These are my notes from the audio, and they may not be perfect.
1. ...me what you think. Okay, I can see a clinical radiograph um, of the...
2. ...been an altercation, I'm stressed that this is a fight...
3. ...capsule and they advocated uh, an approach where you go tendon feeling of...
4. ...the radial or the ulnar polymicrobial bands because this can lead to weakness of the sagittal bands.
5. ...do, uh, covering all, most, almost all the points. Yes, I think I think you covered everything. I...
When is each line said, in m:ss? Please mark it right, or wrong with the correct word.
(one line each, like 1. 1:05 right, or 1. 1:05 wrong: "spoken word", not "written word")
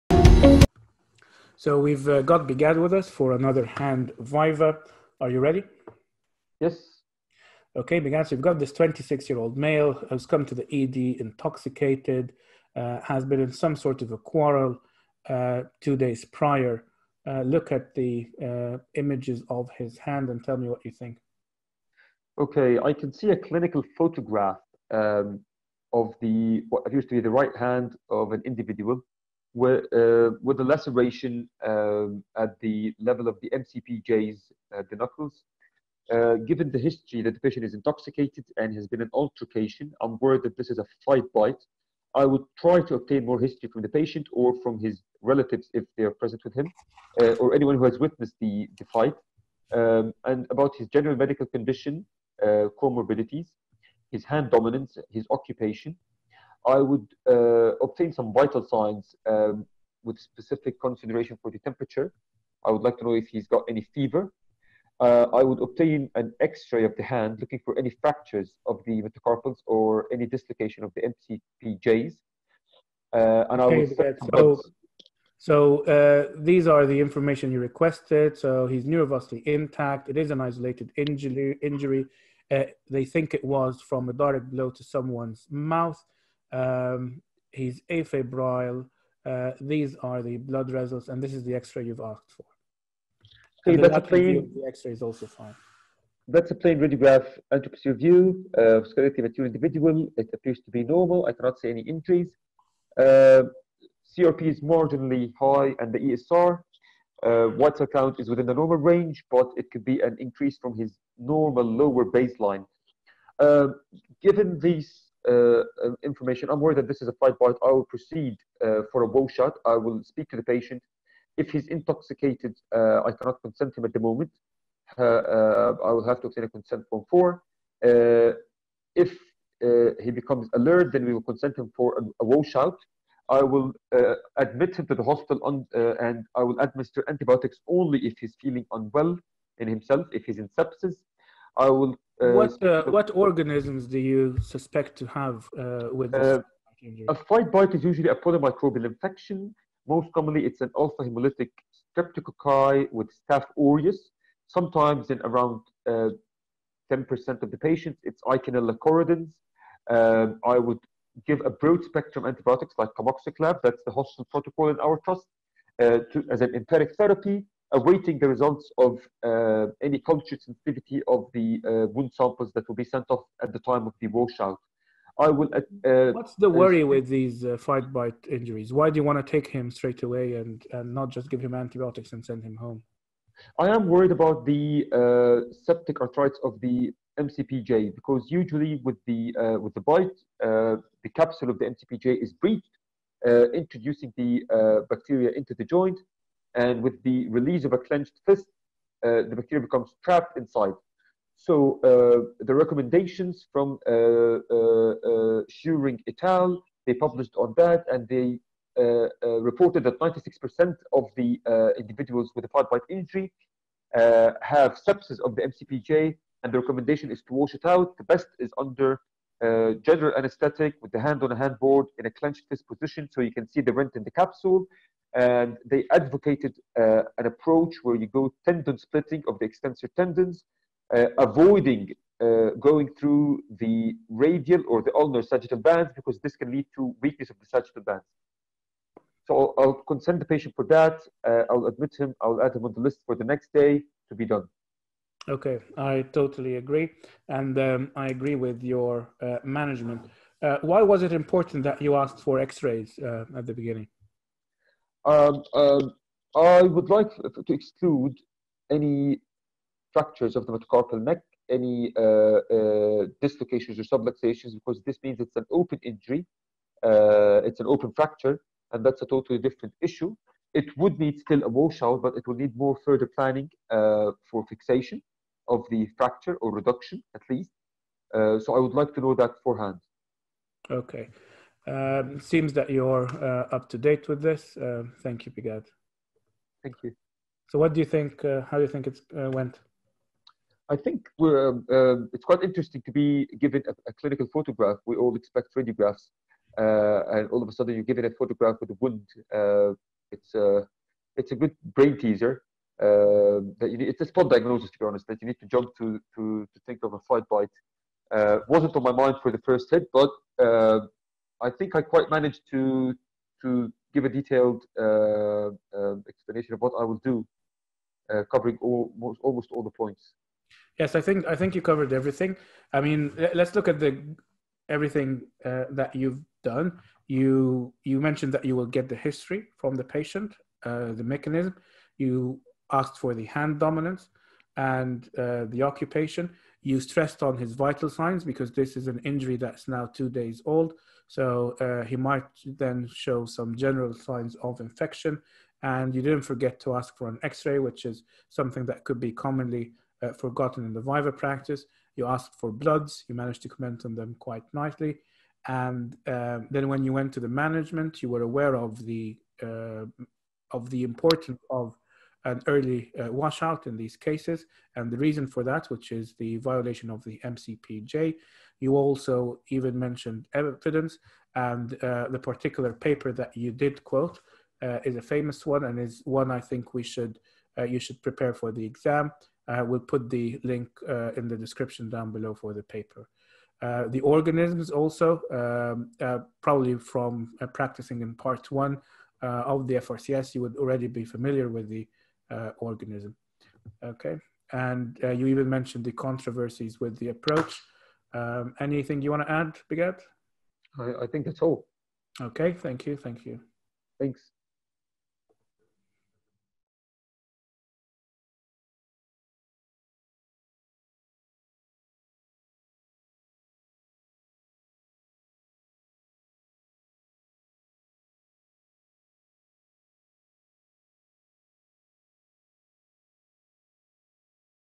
1. 0:20 wrong: "photograph", not "radiograph"
2. 0:38 wrong: "worried", not "stressed"
3. 3:44 wrong: "splitting", not "feeling"
4. 3:53 wrong: "sagittal", not "polymicrobial"
5. 5:17 right.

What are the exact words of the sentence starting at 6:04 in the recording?
And the reason for that, which is the violation of the MCPJ.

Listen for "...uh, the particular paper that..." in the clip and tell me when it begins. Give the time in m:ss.
6:11.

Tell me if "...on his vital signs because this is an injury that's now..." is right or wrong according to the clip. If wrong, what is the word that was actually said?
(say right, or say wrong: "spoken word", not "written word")
right.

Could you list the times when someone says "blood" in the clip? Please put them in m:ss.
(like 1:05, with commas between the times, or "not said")
1:30, 5:52.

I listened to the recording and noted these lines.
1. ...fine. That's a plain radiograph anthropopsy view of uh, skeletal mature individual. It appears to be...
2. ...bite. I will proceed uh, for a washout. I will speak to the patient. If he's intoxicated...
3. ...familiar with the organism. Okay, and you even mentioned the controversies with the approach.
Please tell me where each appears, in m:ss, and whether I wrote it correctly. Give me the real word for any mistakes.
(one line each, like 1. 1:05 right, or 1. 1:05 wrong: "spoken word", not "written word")
1. 1:35 right
2. 1:57 right
3. 6:31 right.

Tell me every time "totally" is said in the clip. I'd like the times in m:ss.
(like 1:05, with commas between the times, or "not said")
4:06, 4:29.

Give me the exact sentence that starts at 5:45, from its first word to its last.
And you didn't forget to ask for an x-ray, which is something that could be commonly uh, forgotten in the viva practice.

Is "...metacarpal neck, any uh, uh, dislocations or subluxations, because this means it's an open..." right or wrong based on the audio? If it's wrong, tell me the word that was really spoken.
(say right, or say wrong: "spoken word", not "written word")
right.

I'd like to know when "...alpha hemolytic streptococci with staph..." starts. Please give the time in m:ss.
2:30.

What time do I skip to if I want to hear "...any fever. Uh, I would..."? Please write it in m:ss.
1:03.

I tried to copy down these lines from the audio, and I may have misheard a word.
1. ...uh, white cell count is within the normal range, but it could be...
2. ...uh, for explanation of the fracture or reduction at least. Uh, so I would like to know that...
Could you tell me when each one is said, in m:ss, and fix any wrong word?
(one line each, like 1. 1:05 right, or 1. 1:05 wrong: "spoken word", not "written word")
1. 1:47 right
2. 4:33 wrong: "fixation", not "explanation".